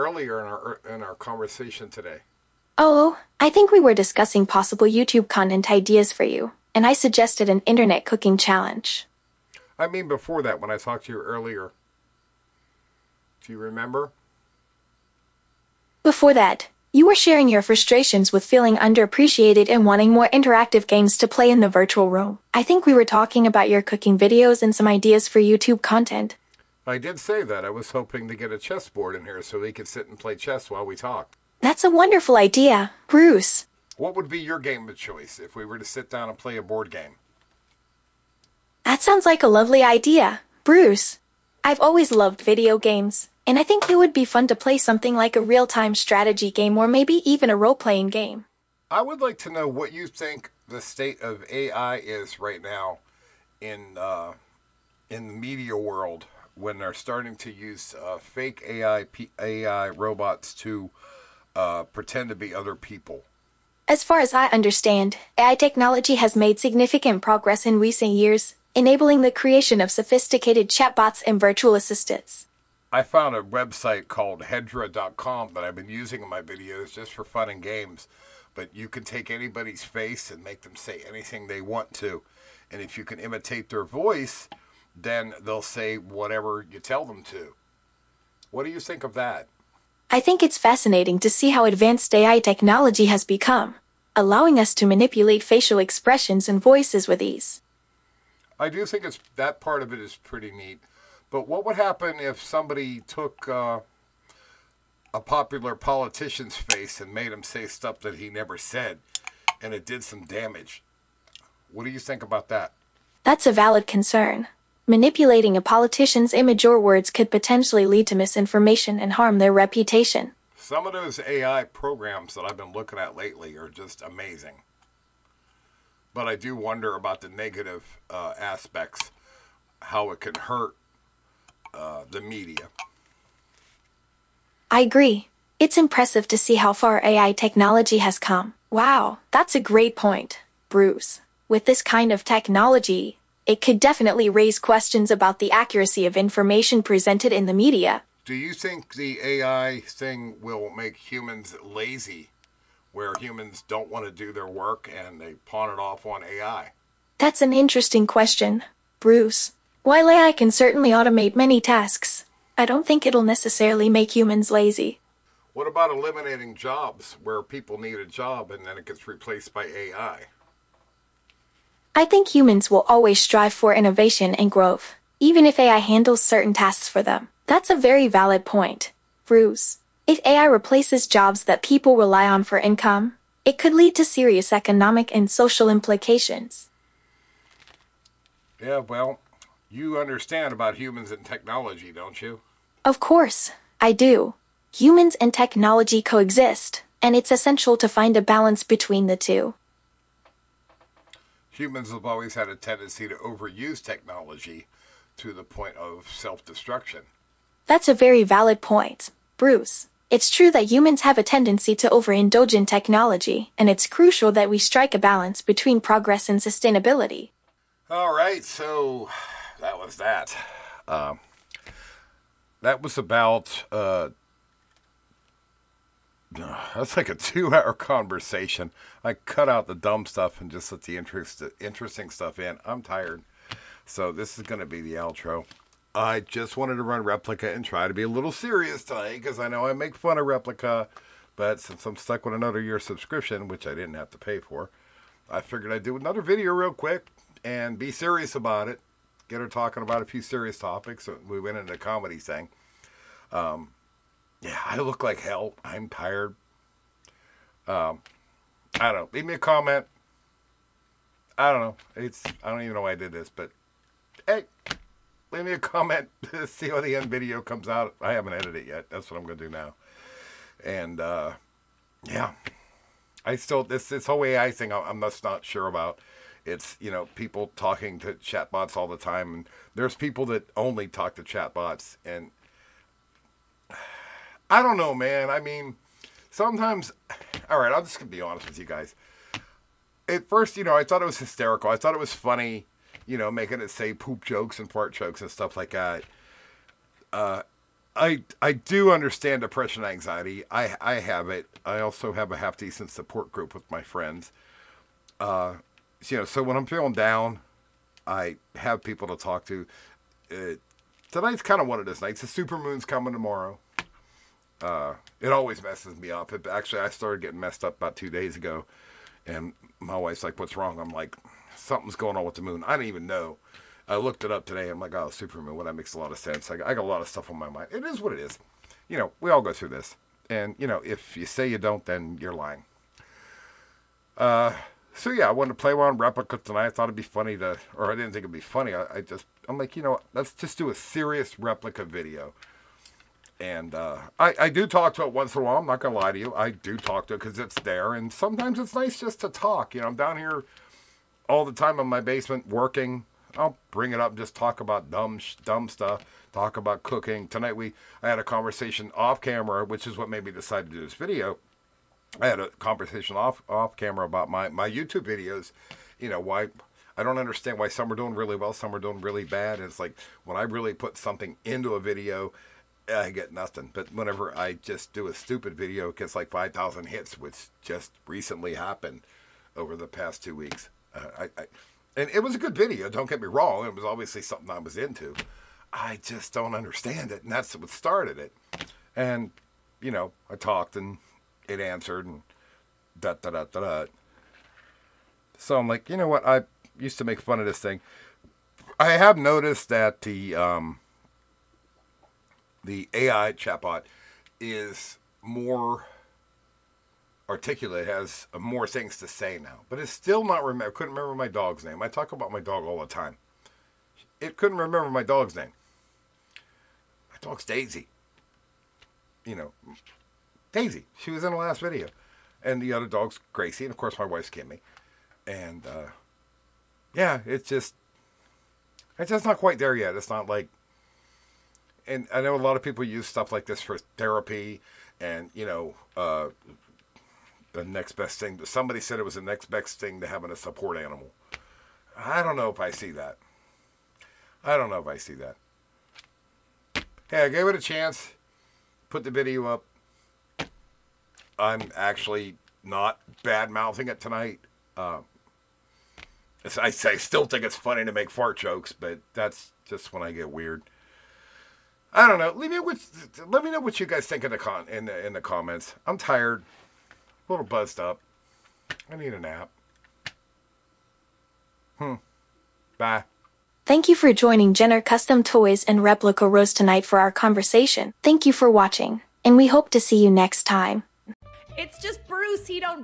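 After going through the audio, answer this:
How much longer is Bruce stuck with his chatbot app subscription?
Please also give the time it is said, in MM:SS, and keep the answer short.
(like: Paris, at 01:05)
Another year, at 04:02.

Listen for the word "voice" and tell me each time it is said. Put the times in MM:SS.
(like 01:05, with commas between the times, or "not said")
01:23, 01:36.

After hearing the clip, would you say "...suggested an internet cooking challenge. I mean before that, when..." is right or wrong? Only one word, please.
right.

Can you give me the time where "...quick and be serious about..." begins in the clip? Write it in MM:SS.
04:06.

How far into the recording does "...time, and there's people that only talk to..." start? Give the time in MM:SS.
04:38.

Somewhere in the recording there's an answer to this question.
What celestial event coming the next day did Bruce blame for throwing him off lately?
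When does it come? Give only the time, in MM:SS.
05:12.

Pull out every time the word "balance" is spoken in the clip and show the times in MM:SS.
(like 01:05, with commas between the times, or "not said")
03:18, 03:34.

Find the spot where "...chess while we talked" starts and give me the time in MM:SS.
00:30.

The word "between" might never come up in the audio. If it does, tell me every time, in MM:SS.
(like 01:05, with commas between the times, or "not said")
03:18, 03:35.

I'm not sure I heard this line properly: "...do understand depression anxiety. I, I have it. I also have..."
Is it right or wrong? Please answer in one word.
right.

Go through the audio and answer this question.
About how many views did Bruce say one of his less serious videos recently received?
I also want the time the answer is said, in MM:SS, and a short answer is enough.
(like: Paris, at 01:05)
5,000, at 06:16.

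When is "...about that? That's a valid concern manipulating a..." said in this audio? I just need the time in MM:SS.
01:52.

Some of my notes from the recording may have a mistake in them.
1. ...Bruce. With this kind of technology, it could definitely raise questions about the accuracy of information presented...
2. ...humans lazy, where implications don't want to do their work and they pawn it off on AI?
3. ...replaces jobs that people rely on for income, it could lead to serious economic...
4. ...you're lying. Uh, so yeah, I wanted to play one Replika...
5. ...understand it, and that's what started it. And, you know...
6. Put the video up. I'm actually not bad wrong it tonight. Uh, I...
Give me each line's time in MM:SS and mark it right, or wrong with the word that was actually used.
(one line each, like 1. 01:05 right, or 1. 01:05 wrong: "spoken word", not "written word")
1. 02:20 right
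2. 02:30 wrong: "humans", not "implications"
3. 03:00 right
4. 05:32 right
5. 06:26 right
6. 07:28 wrong: "mouthing", not "wrong".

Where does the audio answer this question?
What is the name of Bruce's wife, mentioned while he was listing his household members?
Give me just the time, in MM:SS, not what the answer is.
07:04.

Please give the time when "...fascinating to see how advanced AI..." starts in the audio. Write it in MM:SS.
01:30.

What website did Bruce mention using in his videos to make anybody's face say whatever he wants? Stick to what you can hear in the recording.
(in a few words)
Hedra.com.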